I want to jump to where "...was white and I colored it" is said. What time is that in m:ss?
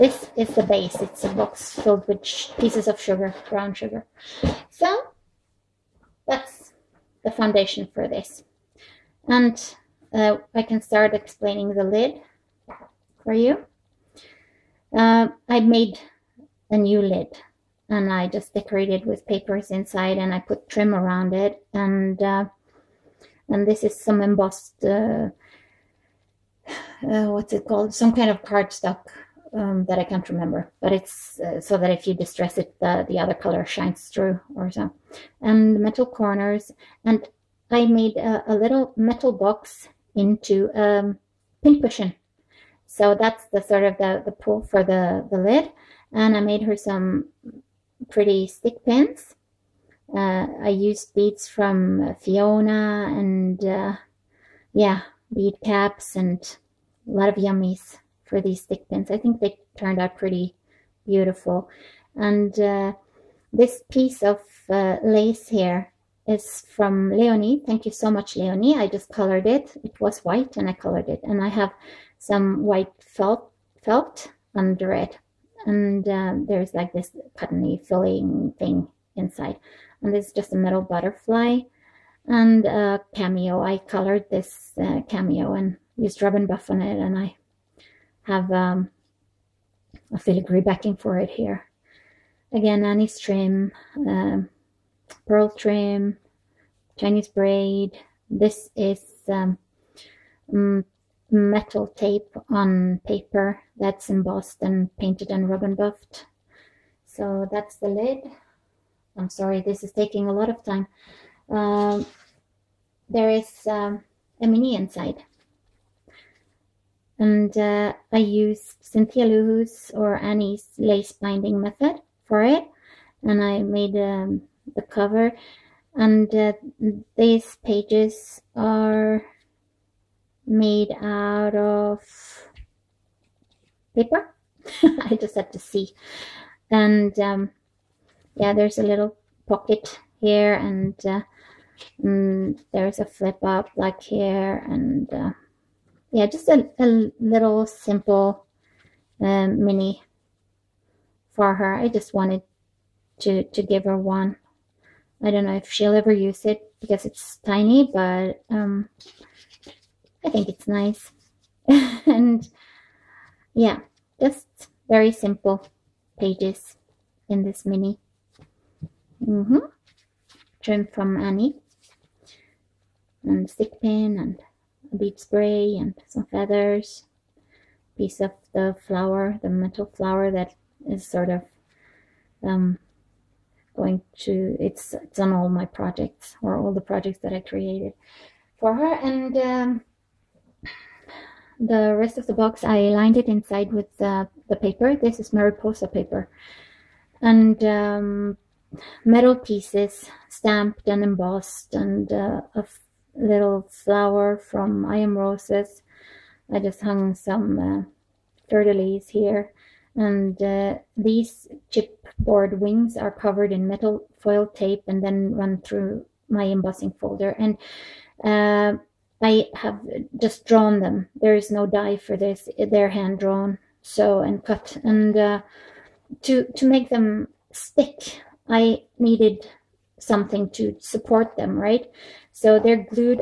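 1:09.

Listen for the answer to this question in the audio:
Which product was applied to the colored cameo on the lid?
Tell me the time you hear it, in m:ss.
1:26.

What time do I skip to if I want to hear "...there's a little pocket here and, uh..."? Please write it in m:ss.
2:18.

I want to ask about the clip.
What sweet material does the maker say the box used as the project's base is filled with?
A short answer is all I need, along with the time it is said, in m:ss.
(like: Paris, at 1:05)
brown sugar, at 0:03.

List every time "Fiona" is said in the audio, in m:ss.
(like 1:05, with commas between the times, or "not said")
0:52.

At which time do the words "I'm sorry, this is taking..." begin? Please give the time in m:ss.
1:49.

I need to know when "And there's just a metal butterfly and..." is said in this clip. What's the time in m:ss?
1:20.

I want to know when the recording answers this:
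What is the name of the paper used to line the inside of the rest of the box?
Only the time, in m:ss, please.
3:15.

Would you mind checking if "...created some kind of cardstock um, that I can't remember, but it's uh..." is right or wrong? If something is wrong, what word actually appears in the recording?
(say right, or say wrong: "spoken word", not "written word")
wrong: "called", not "created".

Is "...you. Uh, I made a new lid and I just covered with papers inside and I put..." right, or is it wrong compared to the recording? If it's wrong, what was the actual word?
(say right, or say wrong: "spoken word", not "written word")
wrong: "decorated", not "covered".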